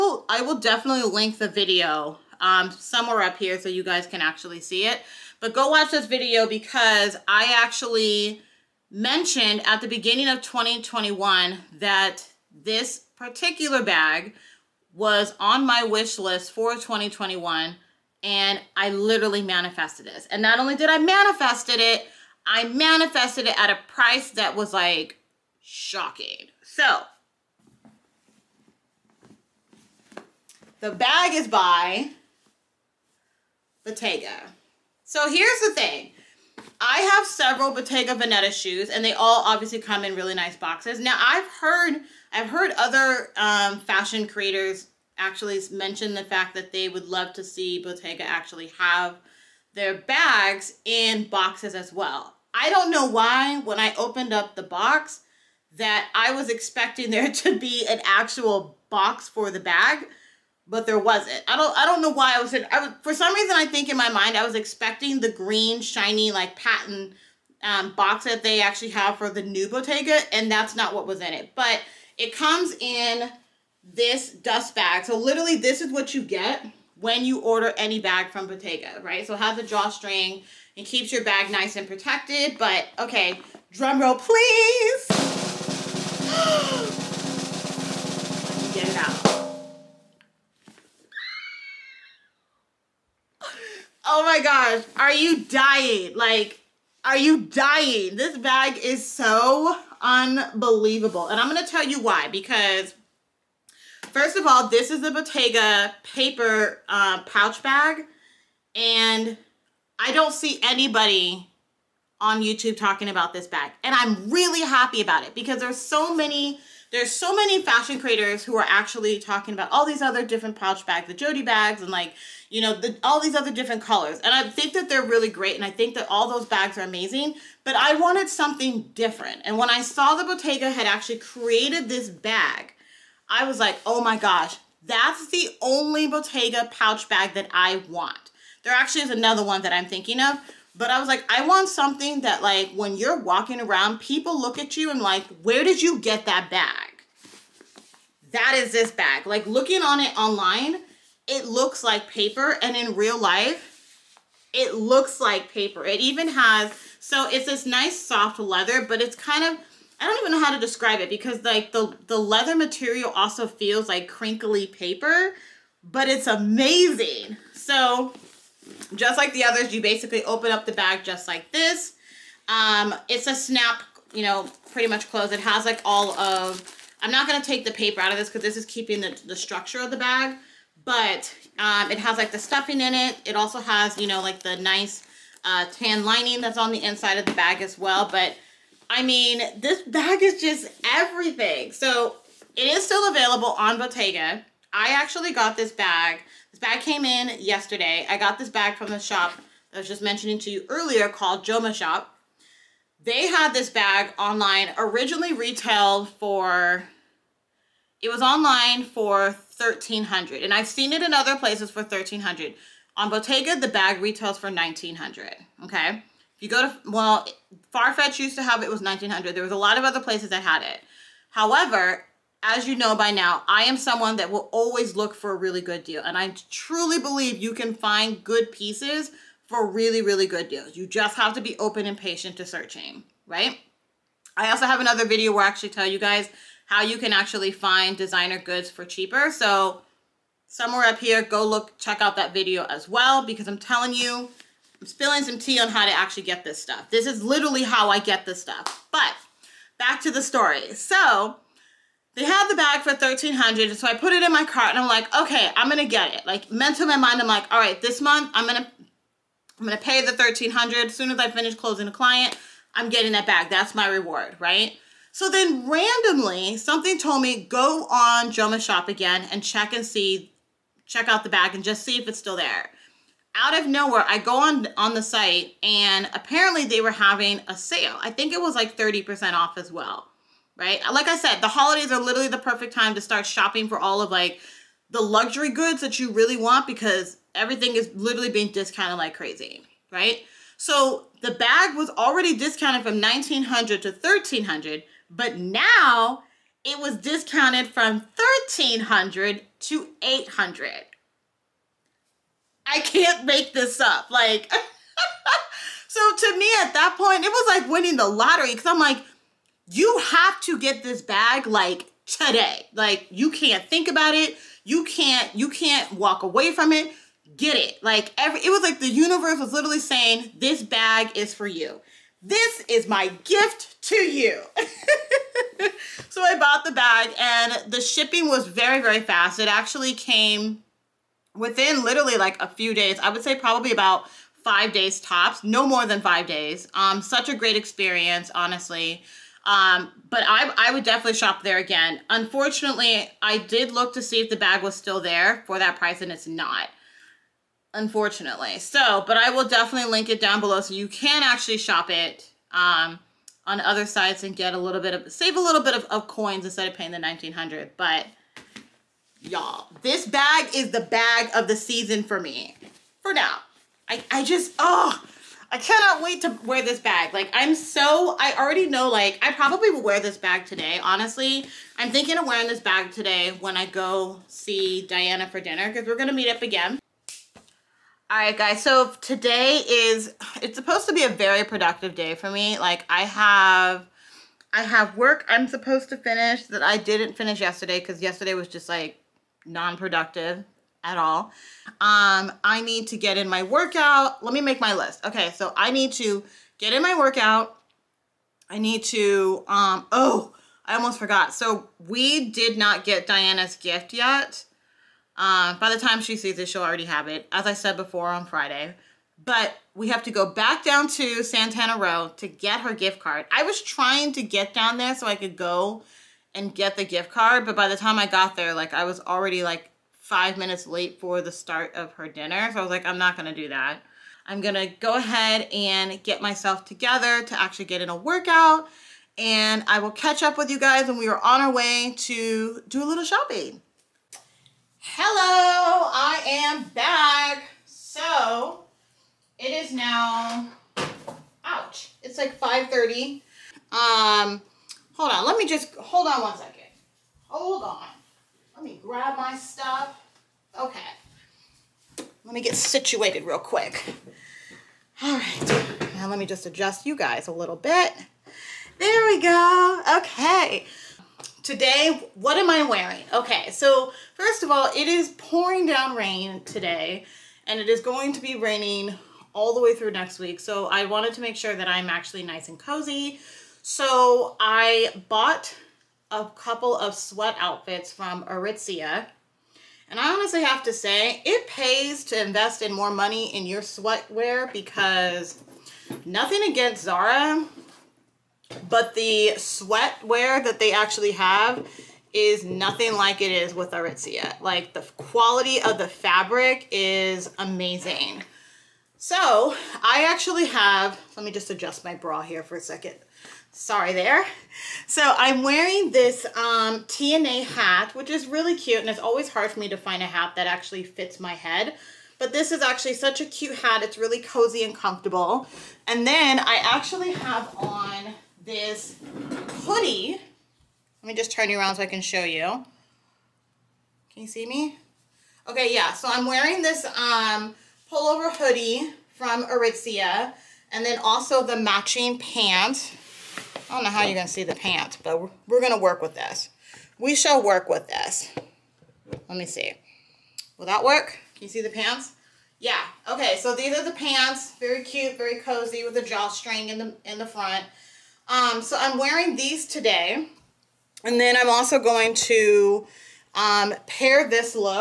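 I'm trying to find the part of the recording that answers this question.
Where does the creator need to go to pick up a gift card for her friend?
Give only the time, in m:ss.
6:51.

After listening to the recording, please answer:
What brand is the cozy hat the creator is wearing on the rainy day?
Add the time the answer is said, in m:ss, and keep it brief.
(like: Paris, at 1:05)
TNA, at 8:26.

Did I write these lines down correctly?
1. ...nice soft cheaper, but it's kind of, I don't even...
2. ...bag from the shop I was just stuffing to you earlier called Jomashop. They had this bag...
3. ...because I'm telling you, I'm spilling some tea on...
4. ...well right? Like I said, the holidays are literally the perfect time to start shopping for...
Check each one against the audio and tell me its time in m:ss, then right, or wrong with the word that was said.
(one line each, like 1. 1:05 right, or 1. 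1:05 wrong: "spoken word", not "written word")
1. 2:37 wrong: "leather", not "cheaper"
2. 3:18 wrong: "mentioning", not "stuffing"
3. 4:03 right
4. 4:39 right.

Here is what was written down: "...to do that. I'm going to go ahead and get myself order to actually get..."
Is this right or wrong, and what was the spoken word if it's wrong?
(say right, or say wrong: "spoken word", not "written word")
wrong: "together", not "order".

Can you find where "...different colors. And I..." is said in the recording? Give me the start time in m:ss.
2:03.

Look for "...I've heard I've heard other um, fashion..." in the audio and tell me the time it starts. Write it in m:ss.
0:41.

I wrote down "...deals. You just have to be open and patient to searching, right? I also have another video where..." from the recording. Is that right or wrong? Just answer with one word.
right.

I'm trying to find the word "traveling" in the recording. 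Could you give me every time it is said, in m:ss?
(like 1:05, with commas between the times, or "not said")
not said.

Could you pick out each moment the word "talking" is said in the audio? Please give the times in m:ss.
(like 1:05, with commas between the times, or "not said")
1:52, 1:59.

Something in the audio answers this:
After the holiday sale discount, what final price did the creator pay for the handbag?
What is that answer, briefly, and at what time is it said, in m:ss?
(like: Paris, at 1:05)
800, at 5:00.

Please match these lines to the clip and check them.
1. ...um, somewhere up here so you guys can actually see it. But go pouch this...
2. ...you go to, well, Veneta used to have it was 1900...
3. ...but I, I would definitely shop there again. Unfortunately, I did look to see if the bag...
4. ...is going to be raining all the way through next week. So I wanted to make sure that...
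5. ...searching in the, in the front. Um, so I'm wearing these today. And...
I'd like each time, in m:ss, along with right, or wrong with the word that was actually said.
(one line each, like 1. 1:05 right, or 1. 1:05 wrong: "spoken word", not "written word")
1. 0:02 wrong: "watch", not "pouch"
2. 3:36 wrong: "Farfetch", not "Veneta"
3. 5:40 right
4. 7:47 right
5. 9:06 wrong: "drawstring", not "searching".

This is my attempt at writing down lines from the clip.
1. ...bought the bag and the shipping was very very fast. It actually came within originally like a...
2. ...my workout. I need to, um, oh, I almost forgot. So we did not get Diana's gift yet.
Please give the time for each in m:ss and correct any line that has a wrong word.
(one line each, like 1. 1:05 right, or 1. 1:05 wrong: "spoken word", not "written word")
1. 5:26 wrong: "literally", not "originally"
2. 6:36 right.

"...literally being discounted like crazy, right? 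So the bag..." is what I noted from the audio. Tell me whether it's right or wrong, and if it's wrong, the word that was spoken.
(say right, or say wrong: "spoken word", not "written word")
right.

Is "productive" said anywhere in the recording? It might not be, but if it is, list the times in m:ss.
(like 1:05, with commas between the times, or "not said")
6:21, 6:29.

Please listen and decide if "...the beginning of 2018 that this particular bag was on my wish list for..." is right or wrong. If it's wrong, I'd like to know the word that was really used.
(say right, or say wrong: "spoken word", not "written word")
wrong: "2021", not "2018".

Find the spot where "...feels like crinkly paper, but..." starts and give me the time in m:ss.
2:43.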